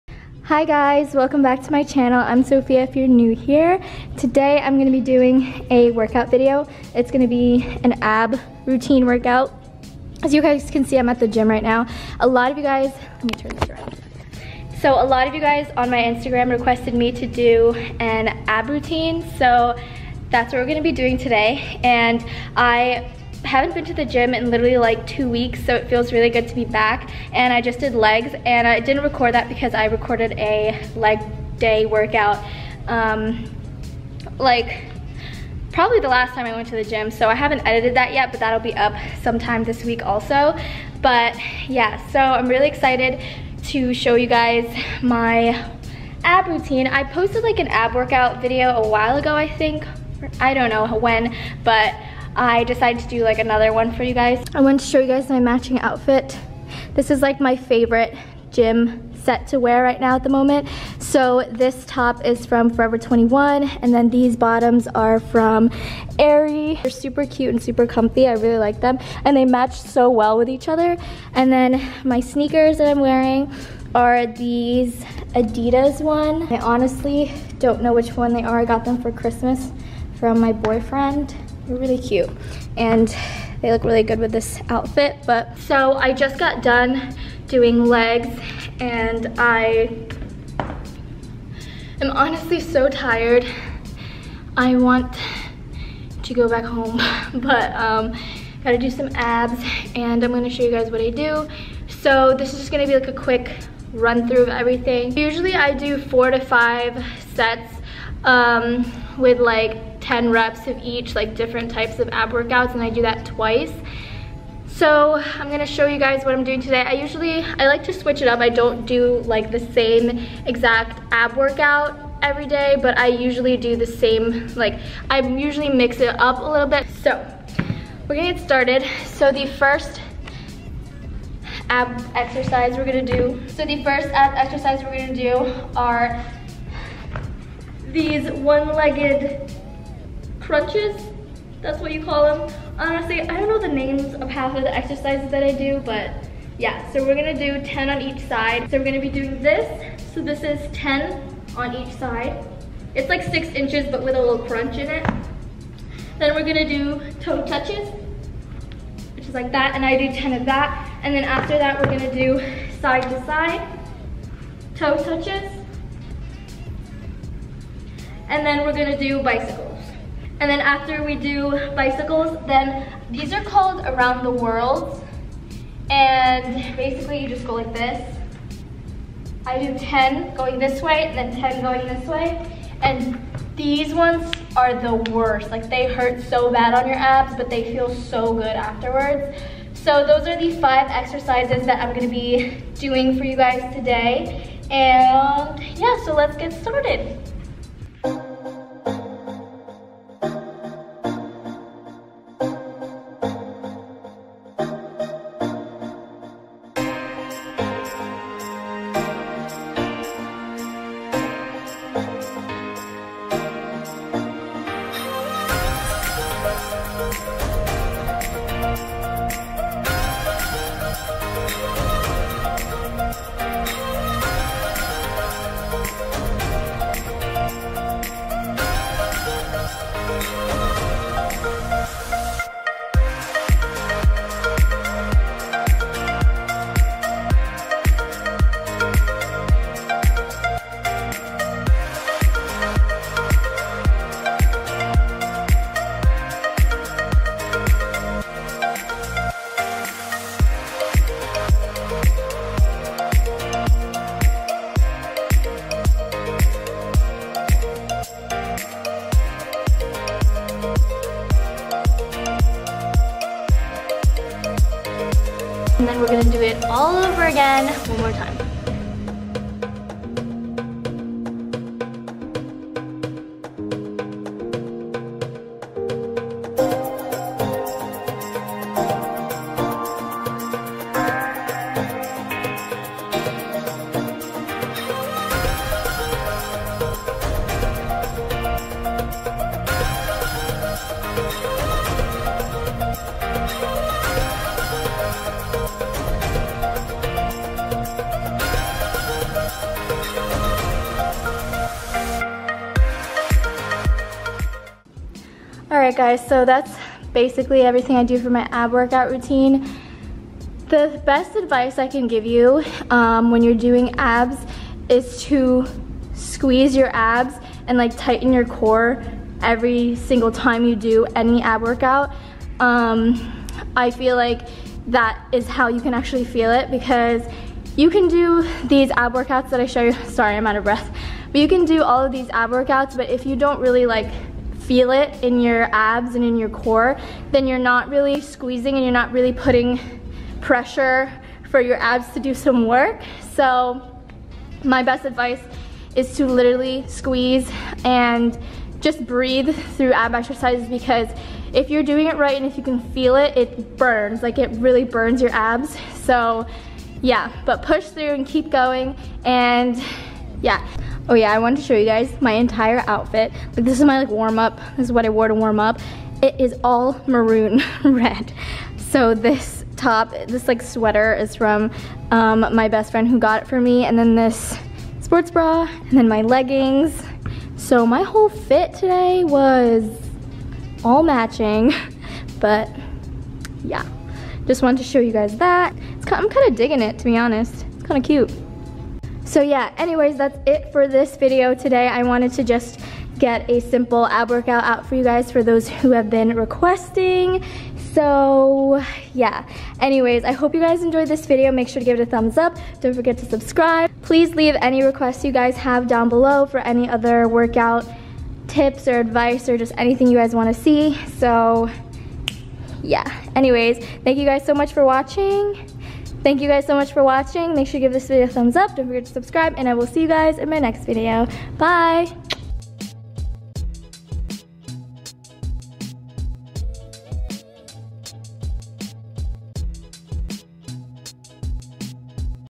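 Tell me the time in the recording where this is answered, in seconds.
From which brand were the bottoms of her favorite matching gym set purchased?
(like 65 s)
66 s.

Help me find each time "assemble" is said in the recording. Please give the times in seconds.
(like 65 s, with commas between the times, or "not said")
not said.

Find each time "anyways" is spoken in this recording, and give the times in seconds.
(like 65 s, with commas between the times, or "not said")
389 s, 399 s, 413 s.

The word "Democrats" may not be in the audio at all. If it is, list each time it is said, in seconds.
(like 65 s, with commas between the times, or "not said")
not said.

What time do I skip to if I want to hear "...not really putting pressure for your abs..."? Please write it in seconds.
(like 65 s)
338 s.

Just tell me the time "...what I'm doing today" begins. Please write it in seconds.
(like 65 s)
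116 s.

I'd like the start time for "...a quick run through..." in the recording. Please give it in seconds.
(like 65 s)
103 s.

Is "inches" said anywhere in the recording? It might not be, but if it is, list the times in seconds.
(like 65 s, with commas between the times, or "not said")
153 s.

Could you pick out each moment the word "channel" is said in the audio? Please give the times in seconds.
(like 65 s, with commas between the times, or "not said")
1 s.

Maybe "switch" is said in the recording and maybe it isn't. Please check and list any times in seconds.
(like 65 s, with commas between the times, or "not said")
117 s.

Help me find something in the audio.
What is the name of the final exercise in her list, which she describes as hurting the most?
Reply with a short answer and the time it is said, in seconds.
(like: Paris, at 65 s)
Around the world, at 173 s.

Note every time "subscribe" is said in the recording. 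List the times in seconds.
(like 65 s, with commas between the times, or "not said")
403 s, 419 s.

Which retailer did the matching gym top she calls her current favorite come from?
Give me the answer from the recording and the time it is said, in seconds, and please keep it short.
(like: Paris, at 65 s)
Forever 21, at 62 s.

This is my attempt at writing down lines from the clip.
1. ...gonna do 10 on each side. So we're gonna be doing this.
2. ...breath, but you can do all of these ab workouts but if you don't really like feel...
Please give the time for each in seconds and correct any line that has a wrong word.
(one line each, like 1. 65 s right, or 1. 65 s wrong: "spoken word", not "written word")
1. 147 s right
2. 330 s right.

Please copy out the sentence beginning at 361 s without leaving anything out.
Oh yeah, I wanted to show you guys my entire outfit.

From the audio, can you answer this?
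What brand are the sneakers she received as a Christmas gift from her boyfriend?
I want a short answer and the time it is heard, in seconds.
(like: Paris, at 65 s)
Adidas, at 75 s.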